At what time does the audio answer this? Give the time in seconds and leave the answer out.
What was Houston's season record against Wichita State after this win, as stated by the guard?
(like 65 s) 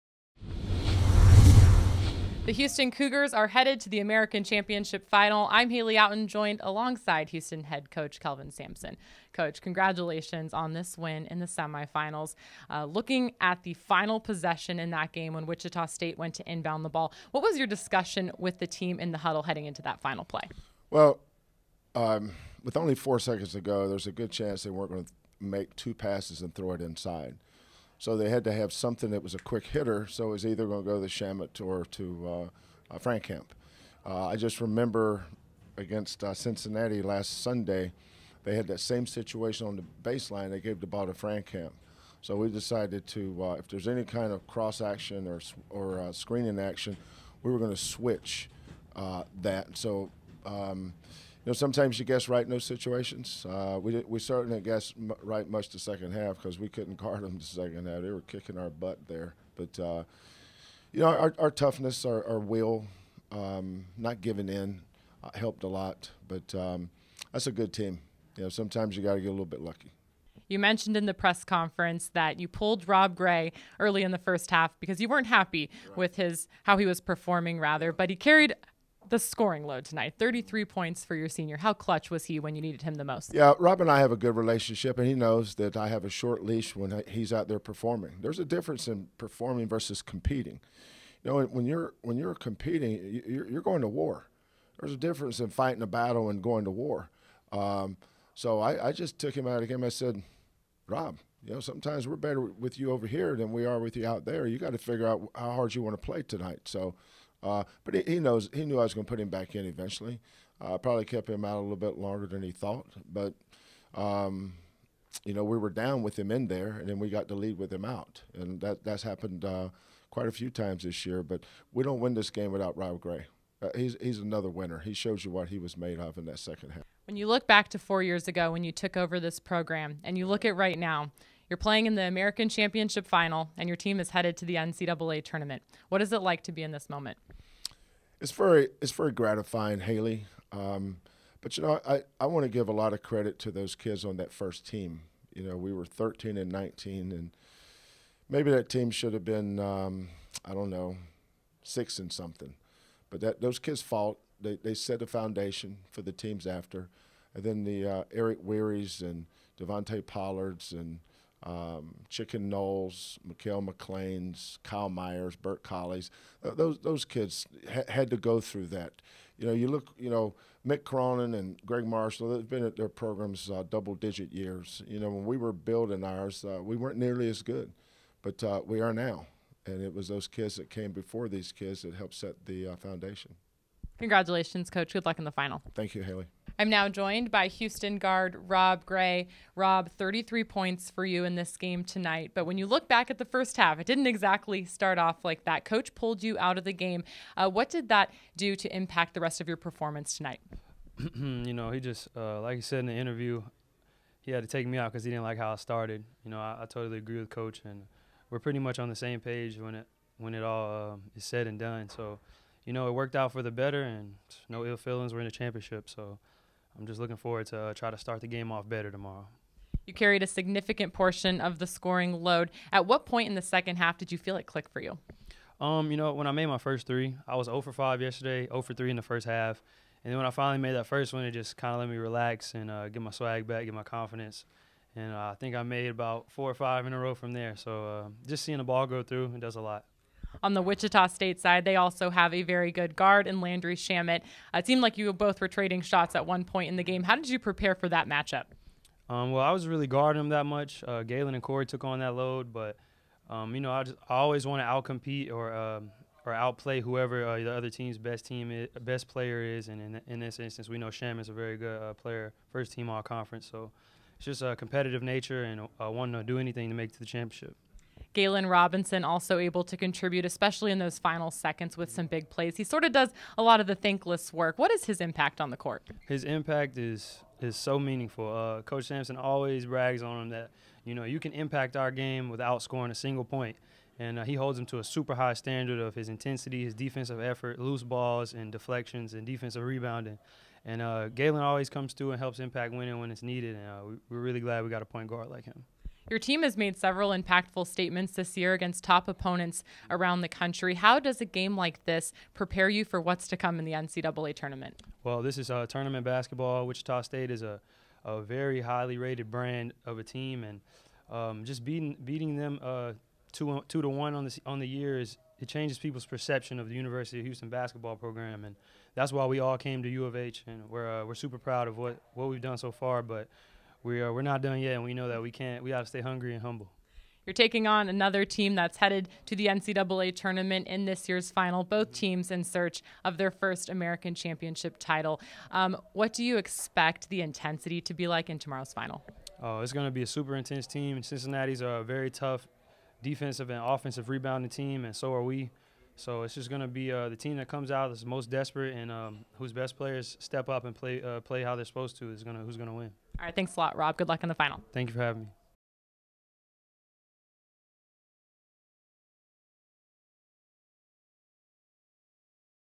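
313 s.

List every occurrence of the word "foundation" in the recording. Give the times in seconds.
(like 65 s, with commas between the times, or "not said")
155 s, 182 s.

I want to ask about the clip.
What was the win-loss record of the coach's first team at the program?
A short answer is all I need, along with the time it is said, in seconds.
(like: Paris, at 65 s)
13 and 19, at 145 s.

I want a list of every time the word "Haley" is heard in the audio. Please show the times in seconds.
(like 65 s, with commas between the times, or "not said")
5 s, 139 s, 186 s.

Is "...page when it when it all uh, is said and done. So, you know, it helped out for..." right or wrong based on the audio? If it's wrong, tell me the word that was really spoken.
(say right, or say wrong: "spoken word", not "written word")
wrong: "worked", not "helped".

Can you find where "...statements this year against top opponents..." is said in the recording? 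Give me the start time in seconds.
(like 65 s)
297 s.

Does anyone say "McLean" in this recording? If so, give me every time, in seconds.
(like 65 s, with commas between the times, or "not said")
163 s.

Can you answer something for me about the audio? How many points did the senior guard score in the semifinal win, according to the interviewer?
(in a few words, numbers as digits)
33.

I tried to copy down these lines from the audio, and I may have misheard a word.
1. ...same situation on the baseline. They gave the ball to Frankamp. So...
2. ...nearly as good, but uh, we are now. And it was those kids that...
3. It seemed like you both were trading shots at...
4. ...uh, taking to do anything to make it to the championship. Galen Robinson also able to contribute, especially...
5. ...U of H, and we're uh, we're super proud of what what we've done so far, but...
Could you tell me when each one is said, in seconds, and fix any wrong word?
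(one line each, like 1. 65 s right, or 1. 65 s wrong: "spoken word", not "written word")
1. 38 s right
2. 176 s right
3. 244 s right
4. 265 s wrong: "wanting", not "taking"
5. 319 s right.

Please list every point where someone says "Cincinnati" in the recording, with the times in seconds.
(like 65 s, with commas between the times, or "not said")
36 s, 341 s.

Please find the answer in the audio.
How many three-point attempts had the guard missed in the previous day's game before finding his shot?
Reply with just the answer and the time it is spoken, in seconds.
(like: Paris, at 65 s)
5, at 227 s.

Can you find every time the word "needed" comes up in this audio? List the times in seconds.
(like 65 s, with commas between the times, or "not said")
82 s, 293 s.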